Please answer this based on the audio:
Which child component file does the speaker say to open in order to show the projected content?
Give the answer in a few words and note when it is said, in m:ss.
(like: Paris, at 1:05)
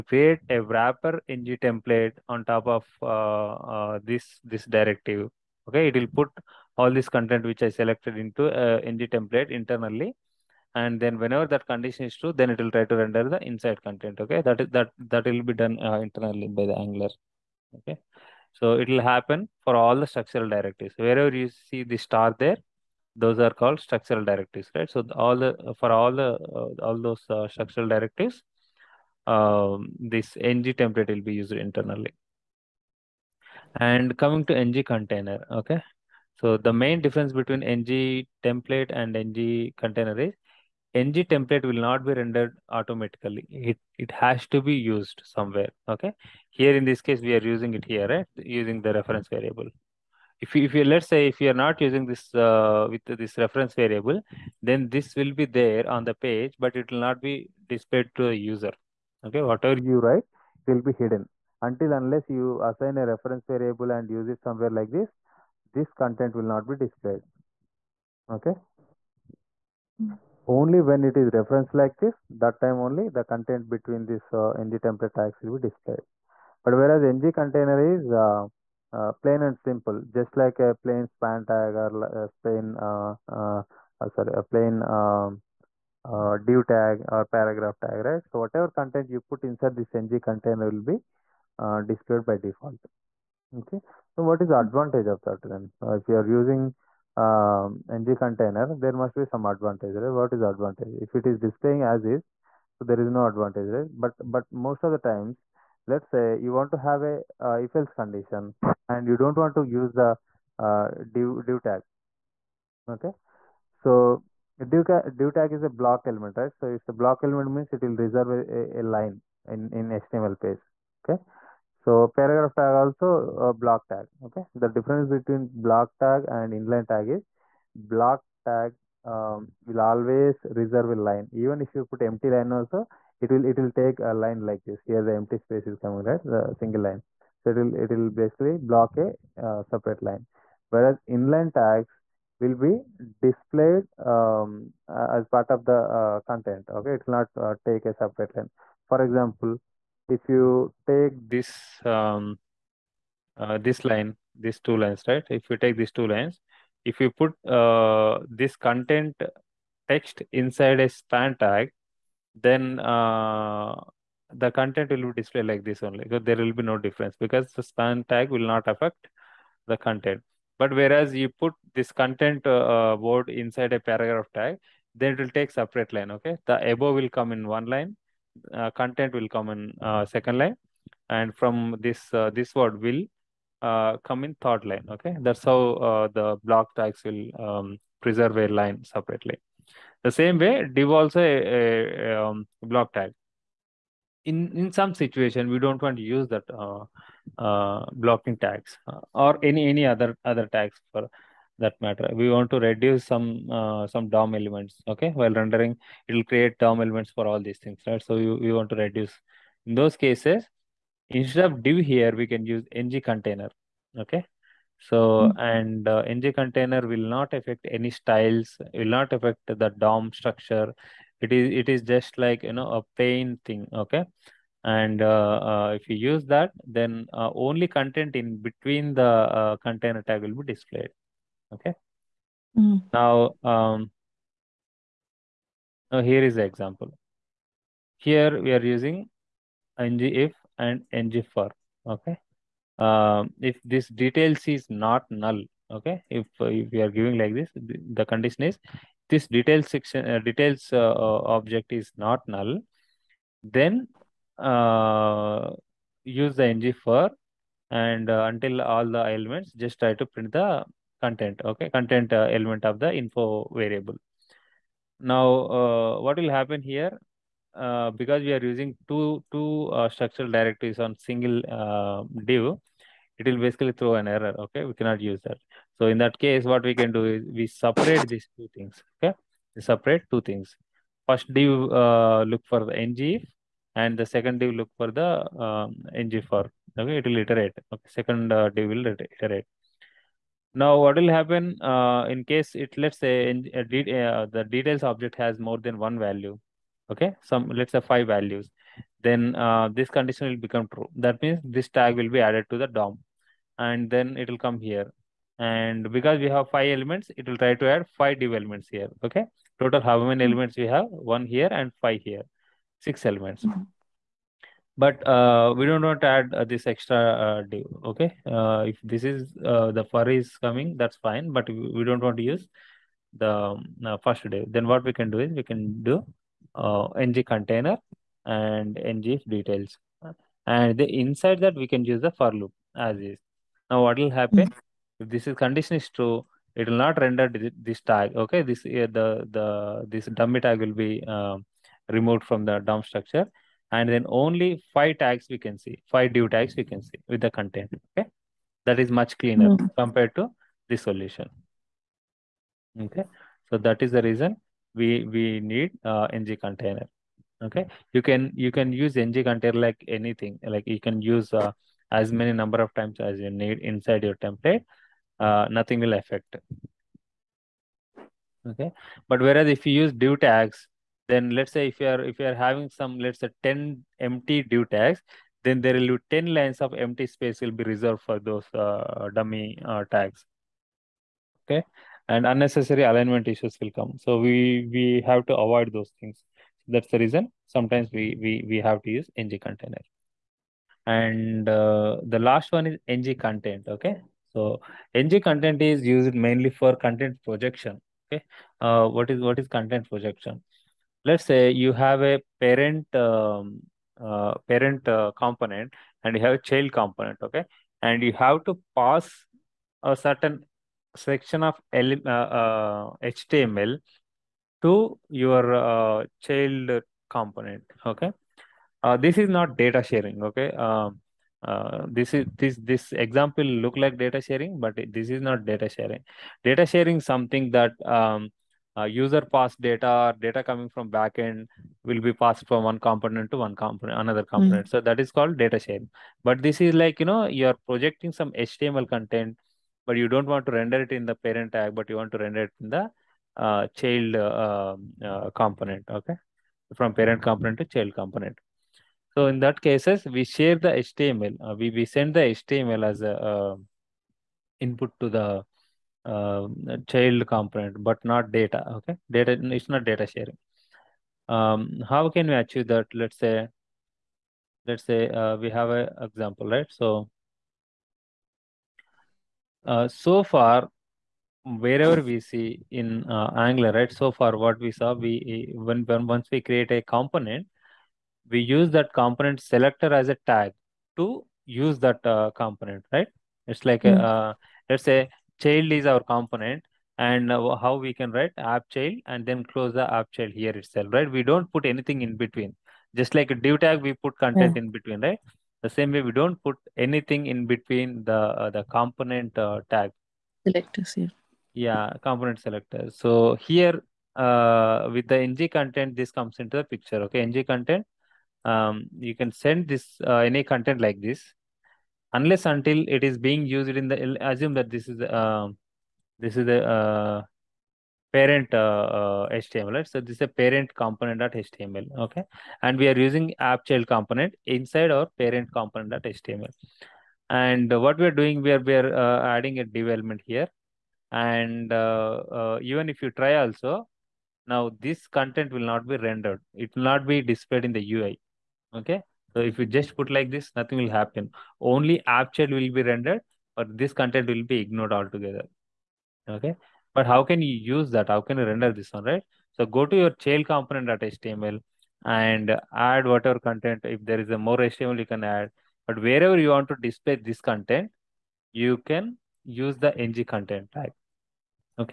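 child component.html, at 9:10.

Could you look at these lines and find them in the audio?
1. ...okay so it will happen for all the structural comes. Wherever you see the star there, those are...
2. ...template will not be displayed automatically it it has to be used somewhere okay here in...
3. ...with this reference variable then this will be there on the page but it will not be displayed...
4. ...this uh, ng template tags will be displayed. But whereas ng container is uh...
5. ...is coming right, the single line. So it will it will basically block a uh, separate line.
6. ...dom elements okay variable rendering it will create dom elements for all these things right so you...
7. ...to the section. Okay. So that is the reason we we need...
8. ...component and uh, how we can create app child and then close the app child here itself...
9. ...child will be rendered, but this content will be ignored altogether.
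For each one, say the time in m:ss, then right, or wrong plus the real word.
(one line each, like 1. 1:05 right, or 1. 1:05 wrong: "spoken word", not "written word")
1. 0:17 wrong: "directives", not "comes"
2. 0:41 wrong: "rendered", not "displayed"
3. 0:52 right
4. 1:14 right
5. 2:15 right
6. 3:24 wrong: "while", not "variable"
7. 5:50 wrong: "solution", not "section"
8. 8:06 wrong: "write", not "create"
9. 9:02 right.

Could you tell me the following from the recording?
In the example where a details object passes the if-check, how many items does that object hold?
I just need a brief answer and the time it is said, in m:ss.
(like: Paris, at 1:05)
5, at 4:57.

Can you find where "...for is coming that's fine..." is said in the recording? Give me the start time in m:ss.
5:19.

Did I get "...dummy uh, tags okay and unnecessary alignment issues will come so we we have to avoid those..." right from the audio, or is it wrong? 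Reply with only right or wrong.
right.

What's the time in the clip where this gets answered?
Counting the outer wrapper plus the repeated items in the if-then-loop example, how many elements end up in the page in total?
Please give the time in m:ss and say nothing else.
5:12.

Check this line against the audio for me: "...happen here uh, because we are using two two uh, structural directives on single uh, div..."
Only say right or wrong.
right.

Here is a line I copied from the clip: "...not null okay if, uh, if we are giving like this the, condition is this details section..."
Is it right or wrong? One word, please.
right.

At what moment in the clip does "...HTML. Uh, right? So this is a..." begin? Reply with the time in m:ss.
8:39.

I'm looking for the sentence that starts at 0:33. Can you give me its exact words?
And coming to ng container, okay.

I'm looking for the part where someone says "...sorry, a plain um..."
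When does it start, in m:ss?
1:24.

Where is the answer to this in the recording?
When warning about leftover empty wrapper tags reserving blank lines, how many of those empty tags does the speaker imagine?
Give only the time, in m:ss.
6:13.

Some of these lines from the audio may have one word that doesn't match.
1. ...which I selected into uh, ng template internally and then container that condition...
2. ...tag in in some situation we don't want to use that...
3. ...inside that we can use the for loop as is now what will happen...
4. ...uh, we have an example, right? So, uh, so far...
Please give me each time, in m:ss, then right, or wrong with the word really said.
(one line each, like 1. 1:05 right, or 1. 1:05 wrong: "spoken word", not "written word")
1. 0:07 wrong: "whenever", not "container"
2. 3:12 right
3. 5:31 right
4. 7:45 right.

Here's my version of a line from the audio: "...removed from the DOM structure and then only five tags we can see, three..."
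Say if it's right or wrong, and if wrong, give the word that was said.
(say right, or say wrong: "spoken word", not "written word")
wrong: "five", not "three".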